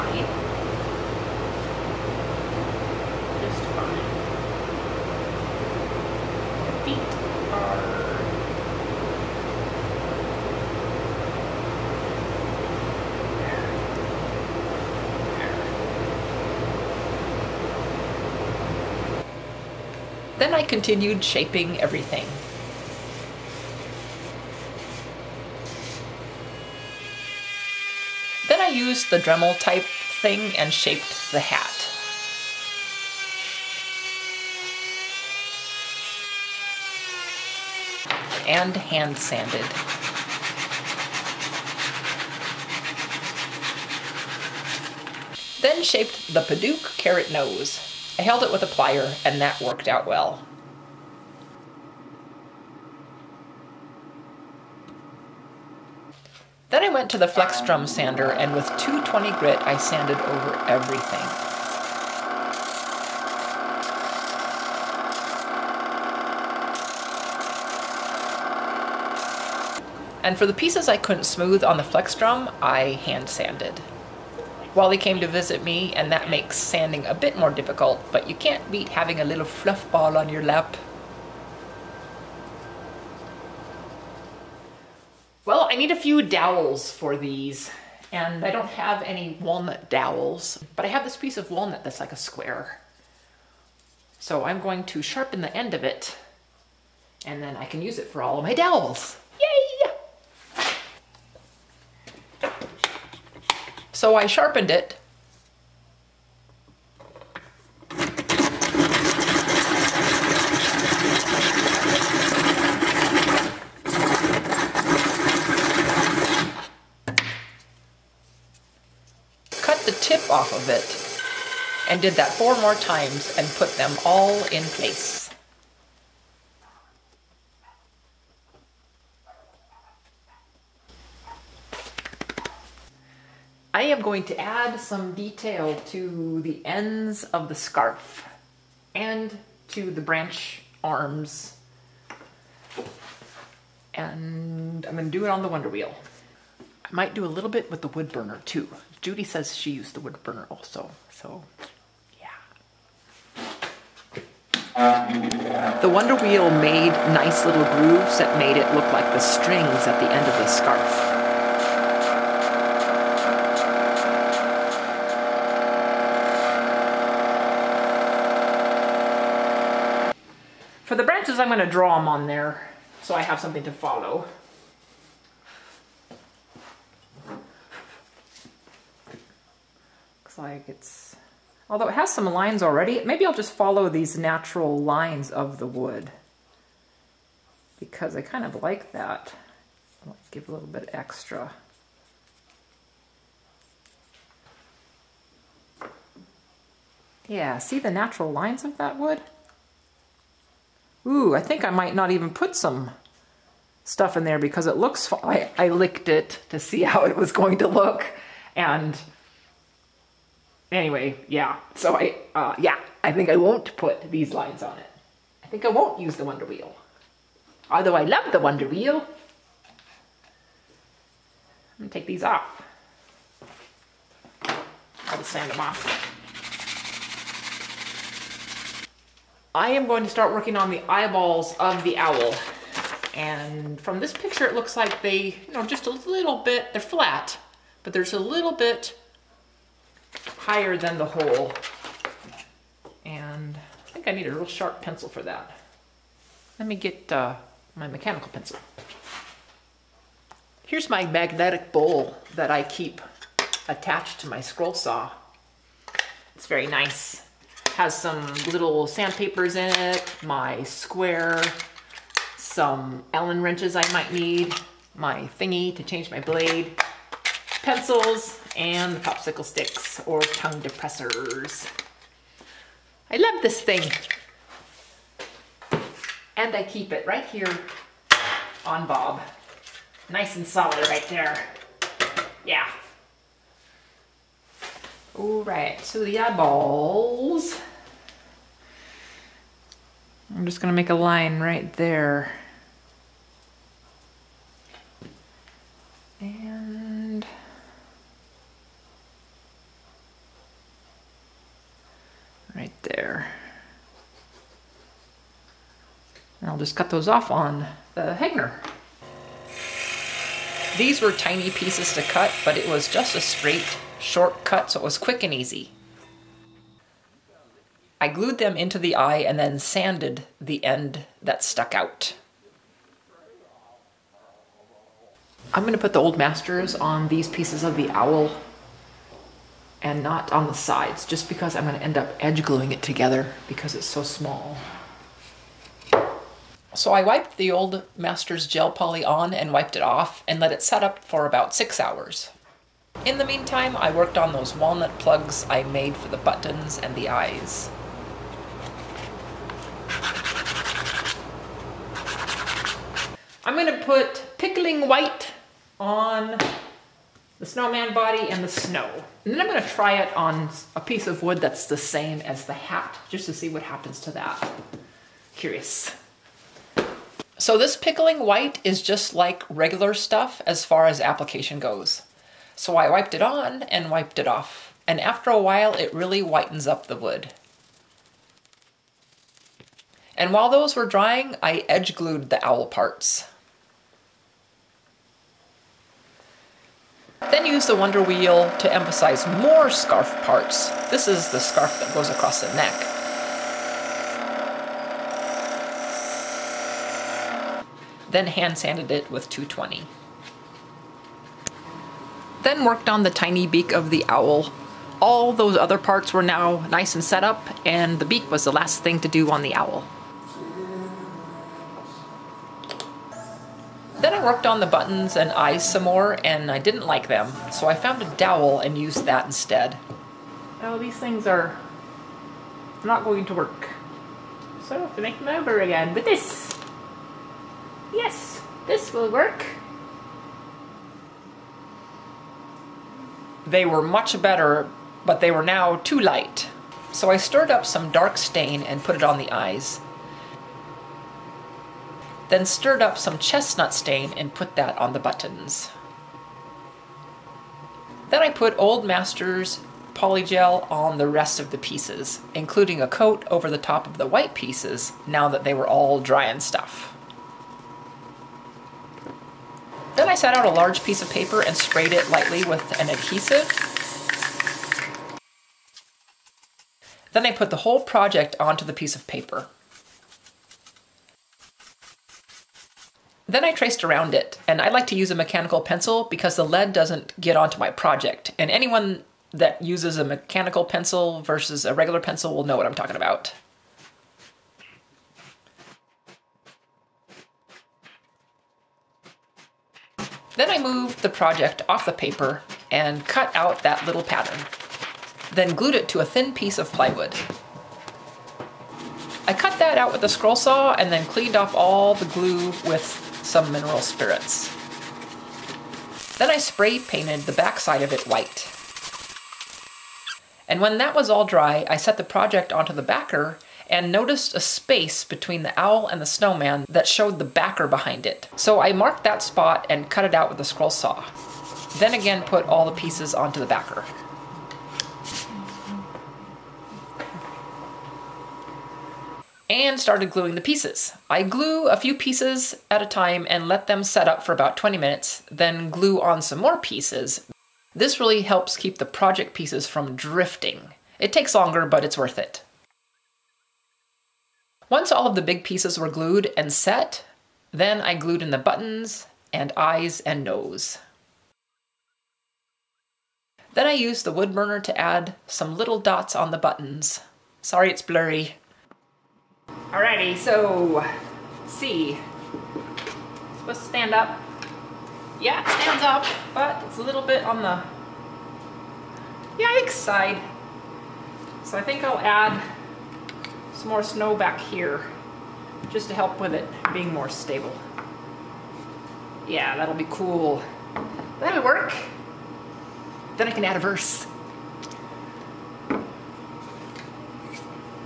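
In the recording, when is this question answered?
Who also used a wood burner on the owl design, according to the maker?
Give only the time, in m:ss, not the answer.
2:29.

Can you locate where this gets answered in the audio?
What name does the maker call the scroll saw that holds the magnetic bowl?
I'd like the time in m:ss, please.
4:38.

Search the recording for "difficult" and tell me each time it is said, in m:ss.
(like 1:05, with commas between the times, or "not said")
1:17.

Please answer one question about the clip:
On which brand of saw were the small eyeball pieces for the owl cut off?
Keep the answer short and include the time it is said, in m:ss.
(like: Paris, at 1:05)
Hegner, at 5:08.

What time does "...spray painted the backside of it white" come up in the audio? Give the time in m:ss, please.
8:26.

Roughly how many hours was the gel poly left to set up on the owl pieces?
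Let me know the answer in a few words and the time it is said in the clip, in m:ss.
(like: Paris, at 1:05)
6, at 5:41.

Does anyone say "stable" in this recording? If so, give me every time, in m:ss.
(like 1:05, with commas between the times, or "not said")
9:37.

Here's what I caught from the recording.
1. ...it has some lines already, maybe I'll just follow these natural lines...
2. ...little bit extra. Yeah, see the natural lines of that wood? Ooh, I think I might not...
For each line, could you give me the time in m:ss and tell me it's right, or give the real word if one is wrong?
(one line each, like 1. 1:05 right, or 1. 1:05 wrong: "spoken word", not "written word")
1. 3:01 right
2. 3:10 right.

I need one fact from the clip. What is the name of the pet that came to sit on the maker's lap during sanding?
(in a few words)
Wally.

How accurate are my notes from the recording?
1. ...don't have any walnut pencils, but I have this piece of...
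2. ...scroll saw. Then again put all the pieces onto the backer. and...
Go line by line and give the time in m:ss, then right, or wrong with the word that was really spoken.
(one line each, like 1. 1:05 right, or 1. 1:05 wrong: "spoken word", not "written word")
1. 1:28 wrong: "dowels", not "pencils"
2. 8:40 right.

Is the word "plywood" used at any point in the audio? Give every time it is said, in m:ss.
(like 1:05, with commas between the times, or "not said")
8:16.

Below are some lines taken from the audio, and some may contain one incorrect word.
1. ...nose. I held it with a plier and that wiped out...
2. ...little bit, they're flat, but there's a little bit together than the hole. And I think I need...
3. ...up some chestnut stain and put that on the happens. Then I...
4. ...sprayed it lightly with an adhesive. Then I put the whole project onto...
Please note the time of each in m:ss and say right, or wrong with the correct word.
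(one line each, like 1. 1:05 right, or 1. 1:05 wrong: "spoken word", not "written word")
1. 0:47 wrong: "worked", not "wiped"
2. 3:55 wrong: "higher", not "together"
3. 7:22 wrong: "buttons", not "happens"
4. 7:41 right.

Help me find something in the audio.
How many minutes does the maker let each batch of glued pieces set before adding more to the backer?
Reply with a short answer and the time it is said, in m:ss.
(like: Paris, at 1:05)
20, at 8:54.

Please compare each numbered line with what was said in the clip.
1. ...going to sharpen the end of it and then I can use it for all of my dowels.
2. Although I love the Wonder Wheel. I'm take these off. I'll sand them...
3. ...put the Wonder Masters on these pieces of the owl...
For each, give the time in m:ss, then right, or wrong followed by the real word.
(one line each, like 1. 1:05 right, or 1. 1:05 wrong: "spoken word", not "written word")
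1. 1:34 right
2. 3:37 right
3. 5:25 wrong: "Old", not "Wonder".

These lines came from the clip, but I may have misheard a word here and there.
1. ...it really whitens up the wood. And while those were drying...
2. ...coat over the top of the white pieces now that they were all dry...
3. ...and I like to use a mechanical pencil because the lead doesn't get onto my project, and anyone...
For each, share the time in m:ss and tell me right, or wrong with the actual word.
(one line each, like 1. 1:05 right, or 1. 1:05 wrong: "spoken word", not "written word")
1. 6:15 right
2. 7:32 right
3. 7:54 right.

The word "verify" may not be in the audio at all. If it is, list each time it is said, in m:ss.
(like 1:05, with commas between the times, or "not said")
not said.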